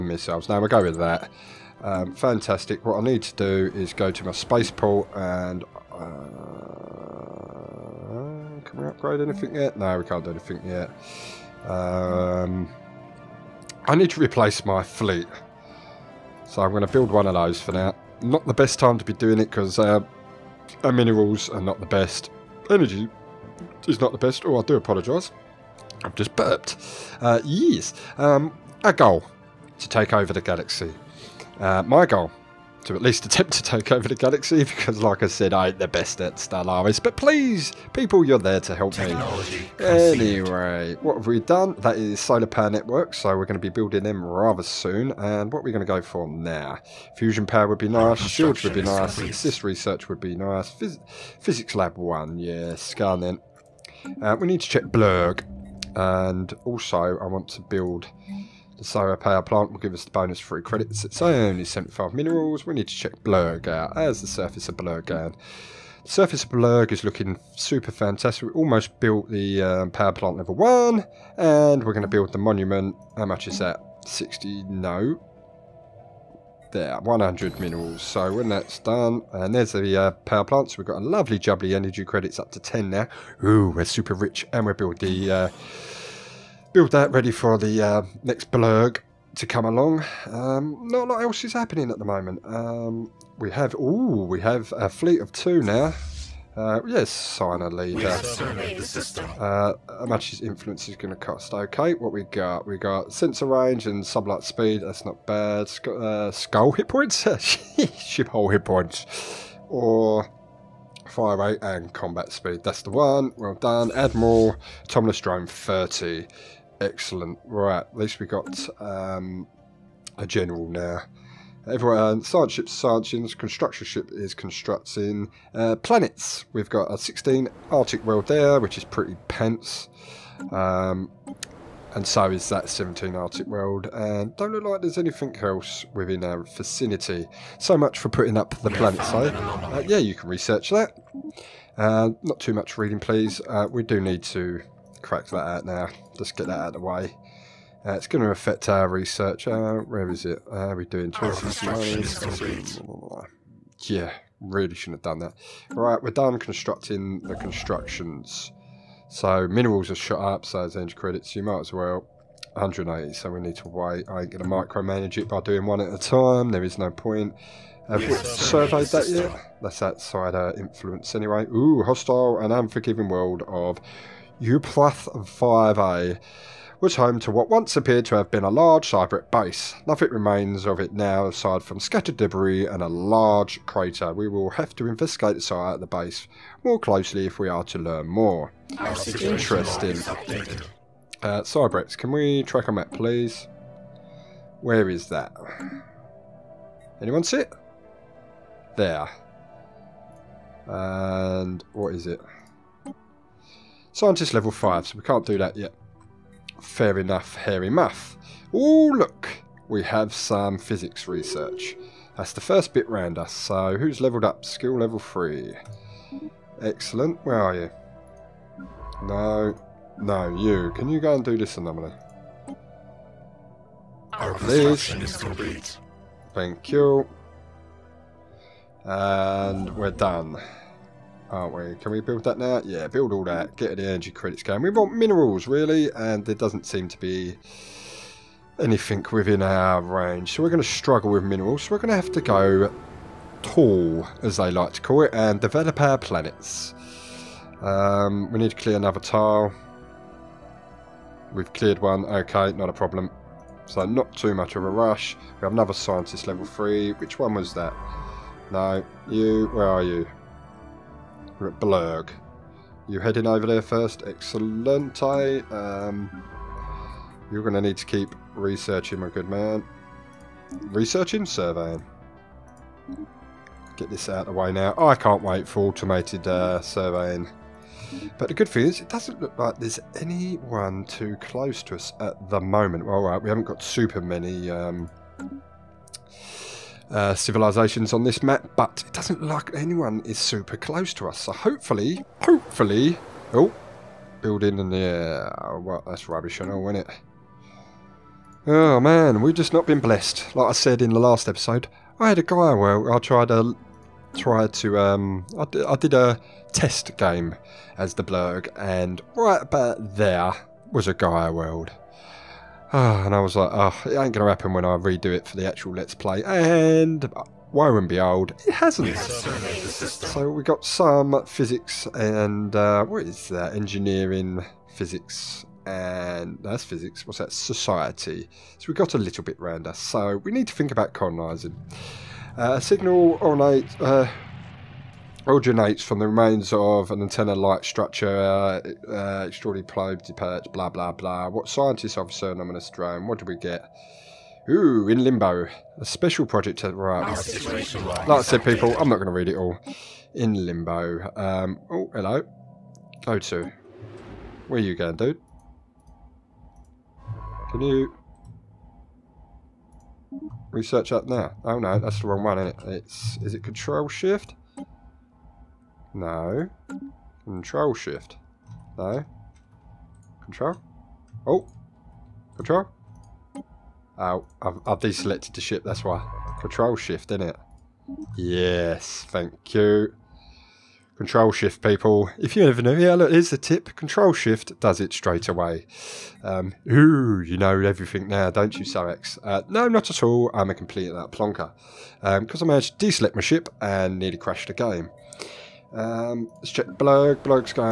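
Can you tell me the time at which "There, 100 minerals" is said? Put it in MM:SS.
01:16.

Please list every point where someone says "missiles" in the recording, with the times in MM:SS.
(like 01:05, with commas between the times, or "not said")
00:00.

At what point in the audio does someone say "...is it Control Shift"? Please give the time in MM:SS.
06:03.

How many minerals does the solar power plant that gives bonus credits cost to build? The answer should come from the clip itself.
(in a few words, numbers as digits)
75.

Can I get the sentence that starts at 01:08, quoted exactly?
We almost built the um, power plant level 1.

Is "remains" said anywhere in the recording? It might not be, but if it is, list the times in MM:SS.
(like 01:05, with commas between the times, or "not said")
03:00, 05:36.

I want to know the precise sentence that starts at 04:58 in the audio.
Oh man, we've just not been blessed.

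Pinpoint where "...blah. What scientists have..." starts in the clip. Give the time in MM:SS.
05:40.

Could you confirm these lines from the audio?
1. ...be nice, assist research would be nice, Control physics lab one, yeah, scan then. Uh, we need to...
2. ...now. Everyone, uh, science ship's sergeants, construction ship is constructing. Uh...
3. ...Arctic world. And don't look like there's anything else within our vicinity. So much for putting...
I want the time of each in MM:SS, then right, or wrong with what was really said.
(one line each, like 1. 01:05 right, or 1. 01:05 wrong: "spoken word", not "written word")
1. 00:48 wrong: "Phys", not "Control"
2. 02:00 right
3. 02:13 right.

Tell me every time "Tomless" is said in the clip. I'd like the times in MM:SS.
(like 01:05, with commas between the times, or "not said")
01:54.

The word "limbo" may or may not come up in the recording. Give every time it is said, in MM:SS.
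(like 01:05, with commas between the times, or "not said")
05:45, 05:50.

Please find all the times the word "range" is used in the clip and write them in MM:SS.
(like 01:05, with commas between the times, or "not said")
01:43, 03:59.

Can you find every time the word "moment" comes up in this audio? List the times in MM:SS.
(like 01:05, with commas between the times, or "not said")
01:32, 04:42.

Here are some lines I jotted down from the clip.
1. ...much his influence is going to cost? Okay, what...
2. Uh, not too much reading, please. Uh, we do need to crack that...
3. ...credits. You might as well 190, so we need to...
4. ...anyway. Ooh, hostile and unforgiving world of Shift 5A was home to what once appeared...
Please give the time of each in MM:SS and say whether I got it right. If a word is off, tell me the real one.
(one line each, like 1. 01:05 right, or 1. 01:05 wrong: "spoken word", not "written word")
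1. 01:40 right
2. 02:21 right
3. 02:40 wrong: "180", not "190"
4. 02:51 wrong: "Uplath", not "Shift".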